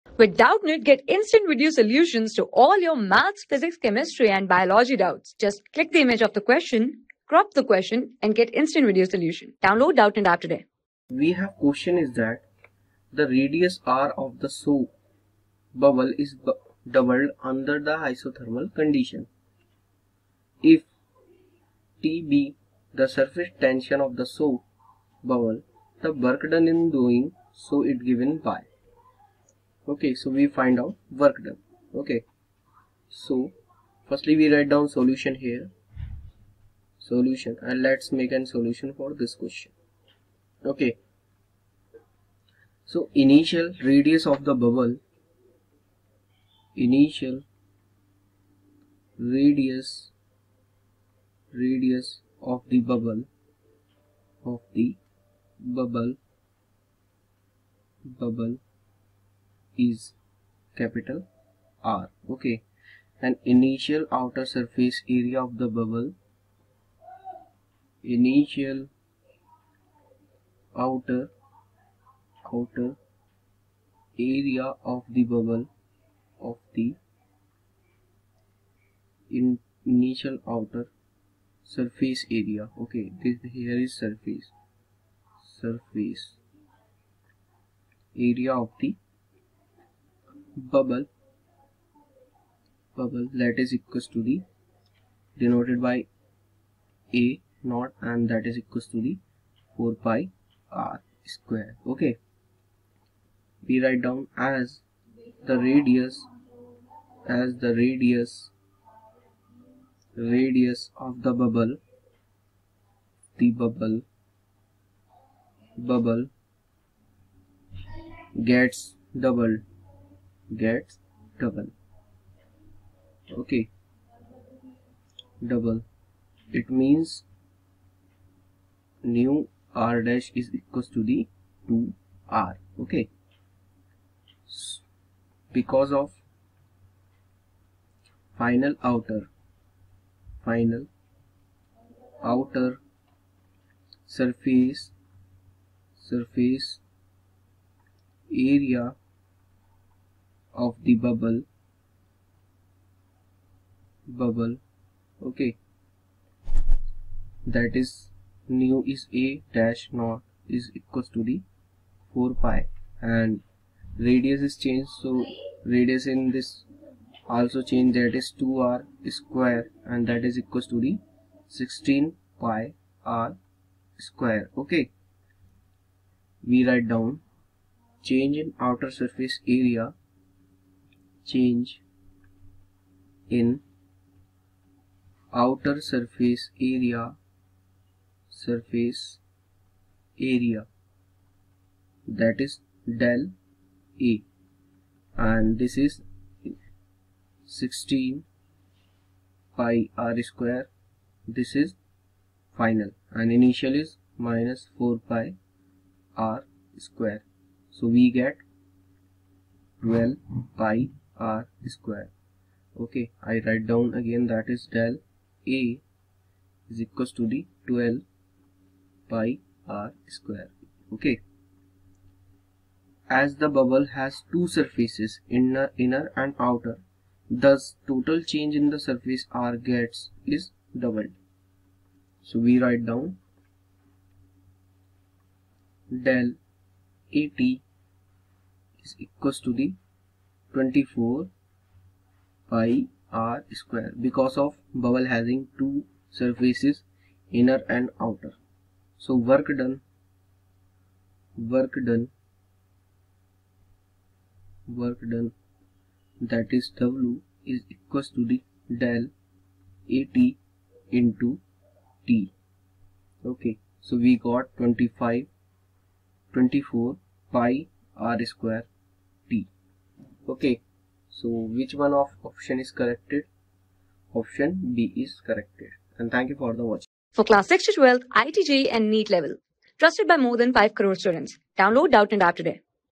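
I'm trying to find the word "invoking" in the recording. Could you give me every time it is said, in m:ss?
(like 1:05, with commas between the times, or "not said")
not said.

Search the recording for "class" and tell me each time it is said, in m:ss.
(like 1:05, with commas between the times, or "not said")
4:37.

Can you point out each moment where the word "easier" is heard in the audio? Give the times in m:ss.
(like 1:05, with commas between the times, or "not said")
not said.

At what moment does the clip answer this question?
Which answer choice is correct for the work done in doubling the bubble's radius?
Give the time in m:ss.
4:34.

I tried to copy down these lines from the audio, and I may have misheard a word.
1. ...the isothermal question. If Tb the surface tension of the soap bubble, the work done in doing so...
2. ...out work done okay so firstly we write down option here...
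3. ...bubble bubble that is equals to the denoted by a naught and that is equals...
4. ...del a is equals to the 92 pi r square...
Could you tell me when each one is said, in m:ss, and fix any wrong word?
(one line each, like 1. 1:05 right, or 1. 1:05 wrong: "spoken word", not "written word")
1. 0:17 wrong: "condition", not "question"
2. 0:30 wrong: "solution", not "option"
3. 1:30 right
4. 3:34 wrong: "12", not "92".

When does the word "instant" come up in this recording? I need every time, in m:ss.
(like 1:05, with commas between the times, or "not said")
0:01, 0:08.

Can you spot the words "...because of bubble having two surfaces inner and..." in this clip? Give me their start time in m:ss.
4:04.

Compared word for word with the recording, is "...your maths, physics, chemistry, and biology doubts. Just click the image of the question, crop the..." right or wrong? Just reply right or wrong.
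right.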